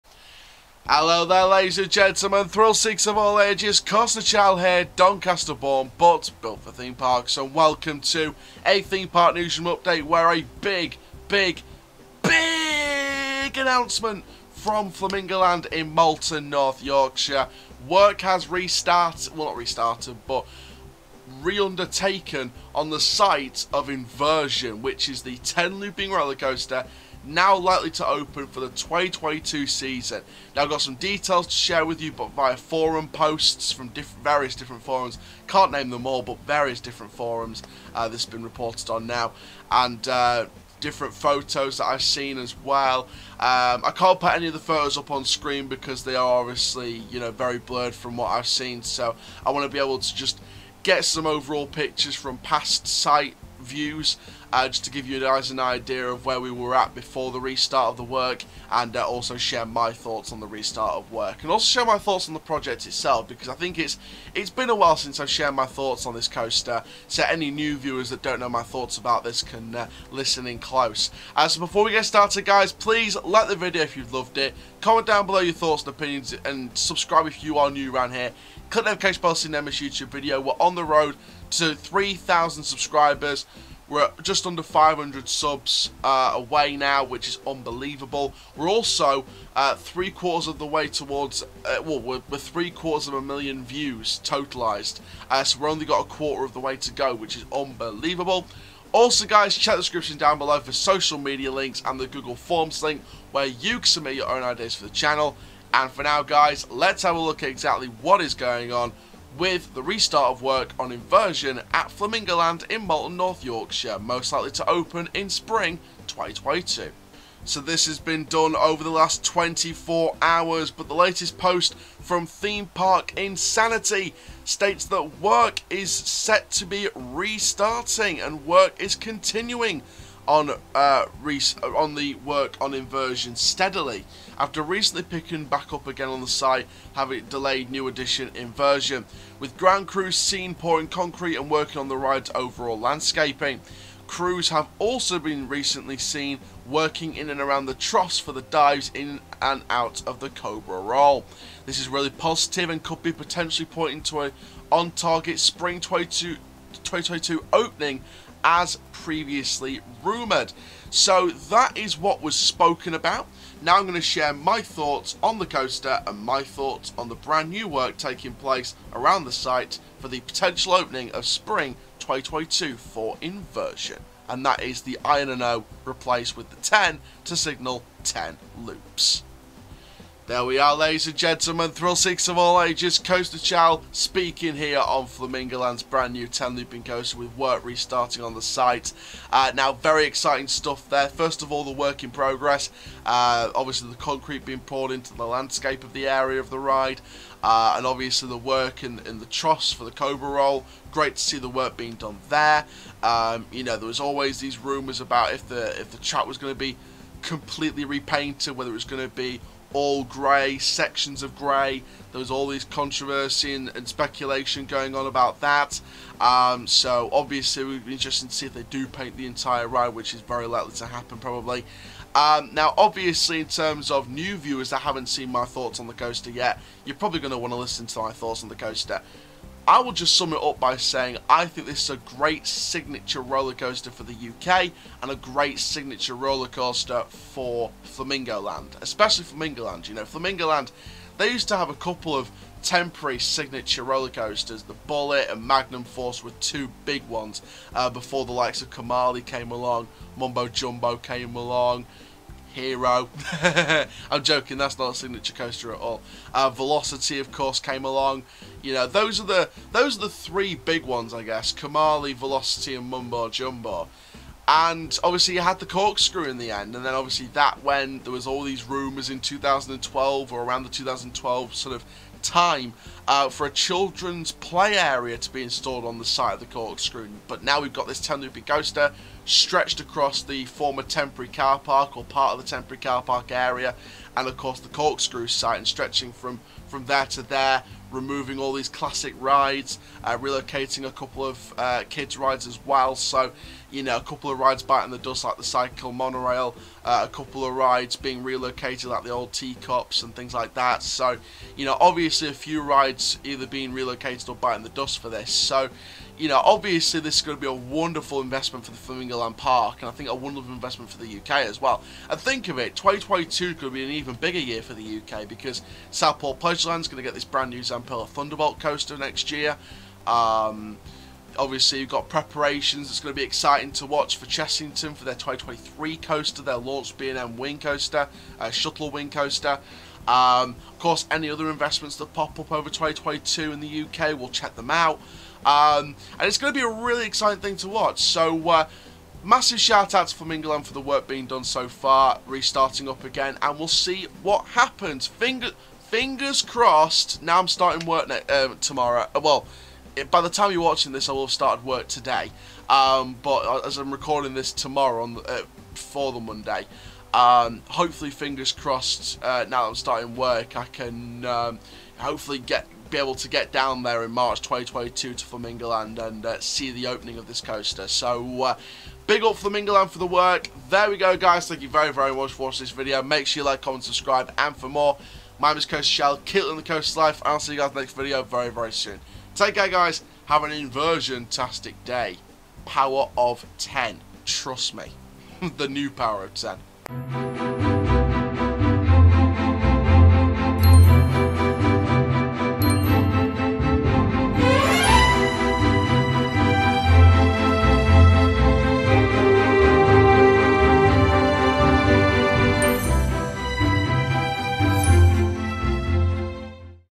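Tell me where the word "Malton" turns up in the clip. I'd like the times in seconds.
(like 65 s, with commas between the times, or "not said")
15 s, 112 s.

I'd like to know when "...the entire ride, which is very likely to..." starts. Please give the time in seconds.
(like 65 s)
219 s.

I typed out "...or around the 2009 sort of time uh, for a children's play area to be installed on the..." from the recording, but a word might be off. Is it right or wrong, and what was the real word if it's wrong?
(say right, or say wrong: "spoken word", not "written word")
wrong: "2012", not "2009".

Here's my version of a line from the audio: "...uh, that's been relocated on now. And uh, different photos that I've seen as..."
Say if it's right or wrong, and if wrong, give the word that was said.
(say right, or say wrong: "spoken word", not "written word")
wrong: "reported", not "relocated".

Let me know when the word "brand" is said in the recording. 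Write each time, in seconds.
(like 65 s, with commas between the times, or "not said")
167 s, 185 s, 317 s.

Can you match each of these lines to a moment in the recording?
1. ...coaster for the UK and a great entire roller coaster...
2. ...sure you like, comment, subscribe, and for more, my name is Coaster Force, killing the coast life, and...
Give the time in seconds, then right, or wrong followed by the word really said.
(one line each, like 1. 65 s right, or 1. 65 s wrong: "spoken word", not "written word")
1. 233 s wrong: "signature", not "entire"
2. 373 s wrong: "Chall", not "Force".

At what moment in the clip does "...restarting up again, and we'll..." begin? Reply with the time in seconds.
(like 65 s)
342 s.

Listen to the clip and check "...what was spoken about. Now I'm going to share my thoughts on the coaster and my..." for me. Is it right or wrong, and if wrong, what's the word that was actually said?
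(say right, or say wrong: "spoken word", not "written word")
right.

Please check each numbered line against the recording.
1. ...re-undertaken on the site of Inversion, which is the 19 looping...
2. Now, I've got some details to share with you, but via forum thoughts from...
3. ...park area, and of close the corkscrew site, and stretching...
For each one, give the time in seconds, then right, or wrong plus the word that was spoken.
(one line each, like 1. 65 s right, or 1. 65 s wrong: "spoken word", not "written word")
1. 21 s wrong: "10", not "19"
2. 30 s wrong: "posts", not "thoughts"
3. 283 s wrong: "course", not "close".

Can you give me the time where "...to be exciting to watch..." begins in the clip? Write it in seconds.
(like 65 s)
323 s.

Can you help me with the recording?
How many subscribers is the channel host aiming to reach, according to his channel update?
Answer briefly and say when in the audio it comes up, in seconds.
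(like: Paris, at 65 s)
3,000, at 81 s.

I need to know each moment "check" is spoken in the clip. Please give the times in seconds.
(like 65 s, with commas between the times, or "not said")
99 s, 334 s.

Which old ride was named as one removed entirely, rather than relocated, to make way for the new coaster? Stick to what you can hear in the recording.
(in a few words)
cycle monorail.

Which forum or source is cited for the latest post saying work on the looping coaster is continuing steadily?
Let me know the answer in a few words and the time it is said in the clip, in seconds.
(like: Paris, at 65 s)
Theme Park Insanity, at 122 s.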